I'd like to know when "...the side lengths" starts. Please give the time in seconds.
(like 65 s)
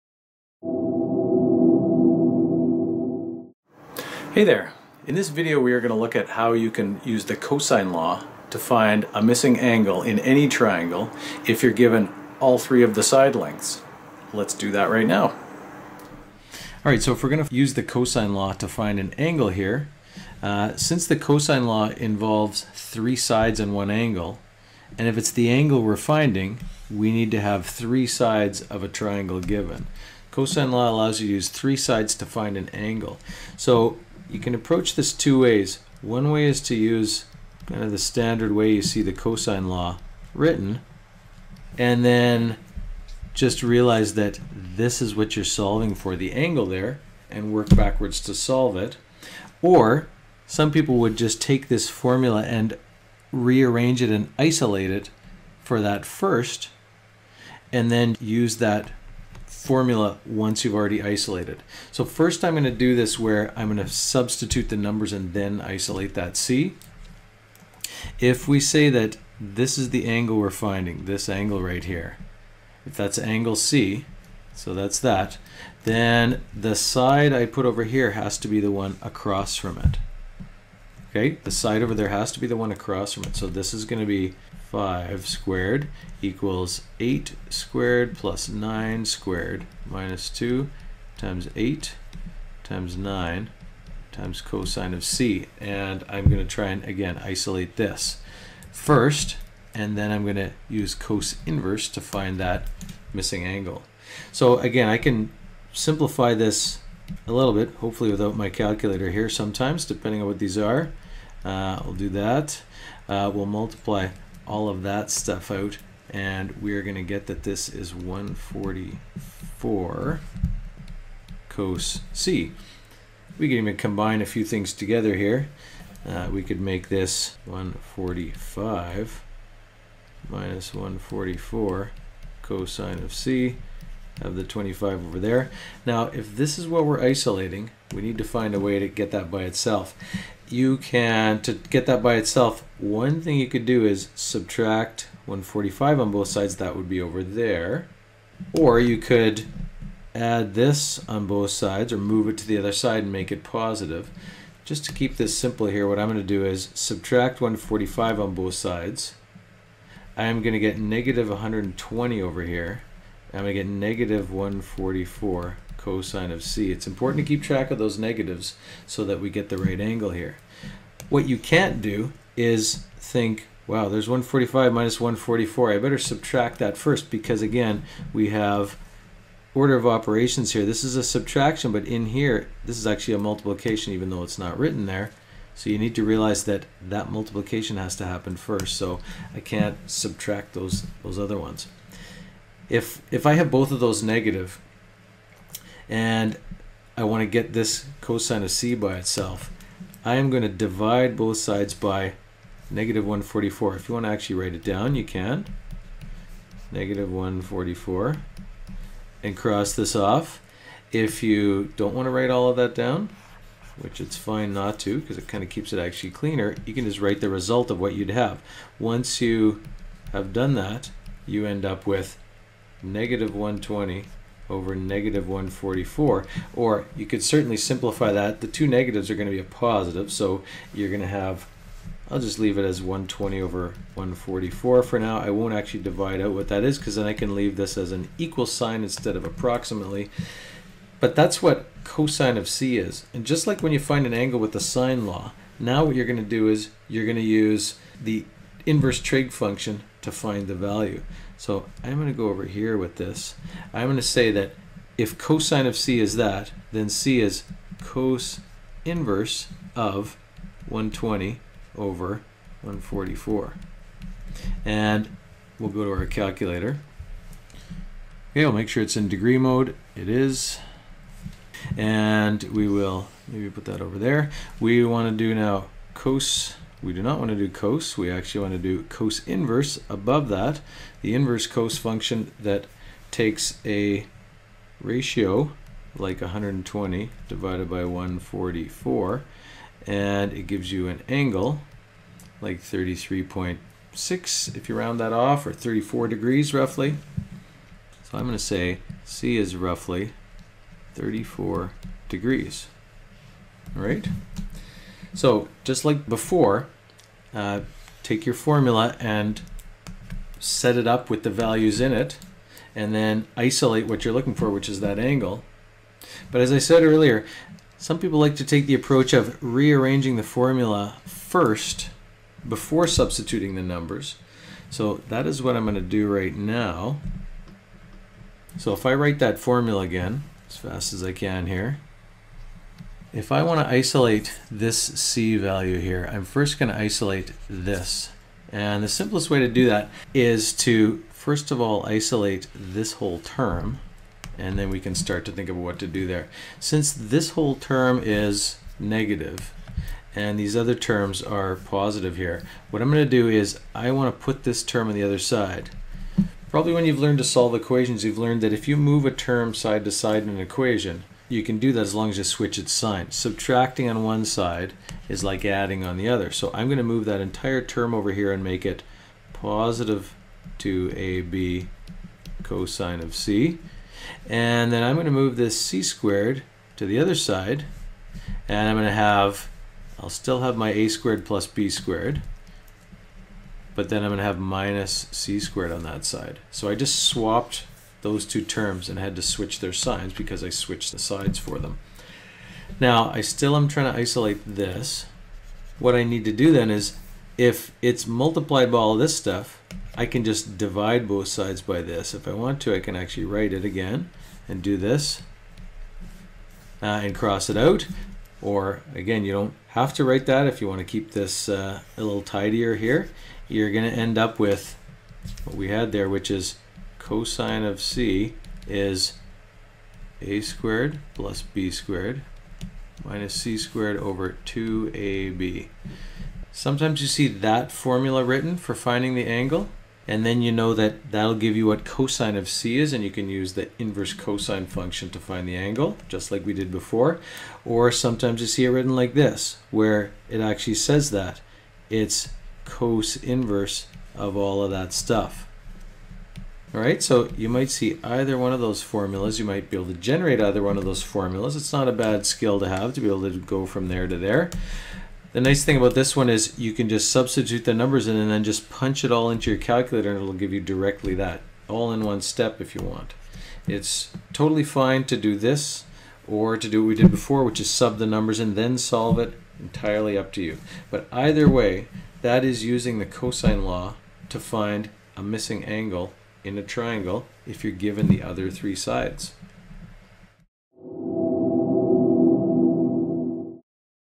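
12 s.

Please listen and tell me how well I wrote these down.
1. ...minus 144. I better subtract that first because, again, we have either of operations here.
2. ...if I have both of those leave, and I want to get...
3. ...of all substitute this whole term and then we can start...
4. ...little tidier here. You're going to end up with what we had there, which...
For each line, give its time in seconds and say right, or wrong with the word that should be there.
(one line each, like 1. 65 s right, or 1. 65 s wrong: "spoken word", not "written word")
1. 174 s wrong: "order", not "either"
2. 193 s wrong: "negative", not "leave"
3. 341 s wrong: "isolate", not "substitute"
4. 412 s right.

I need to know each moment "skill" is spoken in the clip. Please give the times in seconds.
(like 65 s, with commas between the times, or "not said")
452 s.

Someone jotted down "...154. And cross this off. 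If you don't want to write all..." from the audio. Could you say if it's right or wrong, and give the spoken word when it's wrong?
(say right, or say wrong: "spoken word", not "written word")
wrong: "144", not "154".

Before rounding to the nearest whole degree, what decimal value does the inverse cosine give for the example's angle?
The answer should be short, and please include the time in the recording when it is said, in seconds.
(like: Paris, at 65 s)
33.6, at 292 s.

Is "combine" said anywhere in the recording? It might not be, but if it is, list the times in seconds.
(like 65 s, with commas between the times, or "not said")
123 s.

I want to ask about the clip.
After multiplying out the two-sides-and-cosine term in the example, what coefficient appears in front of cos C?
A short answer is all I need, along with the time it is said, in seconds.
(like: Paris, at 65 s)
144, at 117 s.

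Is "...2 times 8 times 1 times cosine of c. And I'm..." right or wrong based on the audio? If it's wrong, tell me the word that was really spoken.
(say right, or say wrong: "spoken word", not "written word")
wrong: "9", not "1".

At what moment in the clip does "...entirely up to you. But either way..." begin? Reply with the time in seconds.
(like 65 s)
469 s.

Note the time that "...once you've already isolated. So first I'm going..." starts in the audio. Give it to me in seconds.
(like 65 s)
60 s.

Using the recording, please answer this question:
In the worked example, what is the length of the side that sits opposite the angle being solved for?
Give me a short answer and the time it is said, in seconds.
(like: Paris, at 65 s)
5, at 84 s.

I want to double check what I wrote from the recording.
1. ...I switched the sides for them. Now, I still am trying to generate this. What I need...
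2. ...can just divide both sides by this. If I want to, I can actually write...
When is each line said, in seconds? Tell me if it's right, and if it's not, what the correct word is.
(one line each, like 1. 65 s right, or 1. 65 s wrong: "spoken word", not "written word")
1. 390 s wrong: "isolate", not "generate"
2. 400 s right.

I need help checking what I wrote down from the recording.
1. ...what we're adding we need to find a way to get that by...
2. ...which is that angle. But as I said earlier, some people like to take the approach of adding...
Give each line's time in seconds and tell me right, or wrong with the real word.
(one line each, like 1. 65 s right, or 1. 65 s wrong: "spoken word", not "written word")
1. 136 s wrong: "isolating", not "adding"
2. 314 s wrong: "rearranging", not "adding".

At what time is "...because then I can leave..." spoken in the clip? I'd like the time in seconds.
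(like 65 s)
236 s.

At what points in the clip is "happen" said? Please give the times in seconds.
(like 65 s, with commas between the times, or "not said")
188 s.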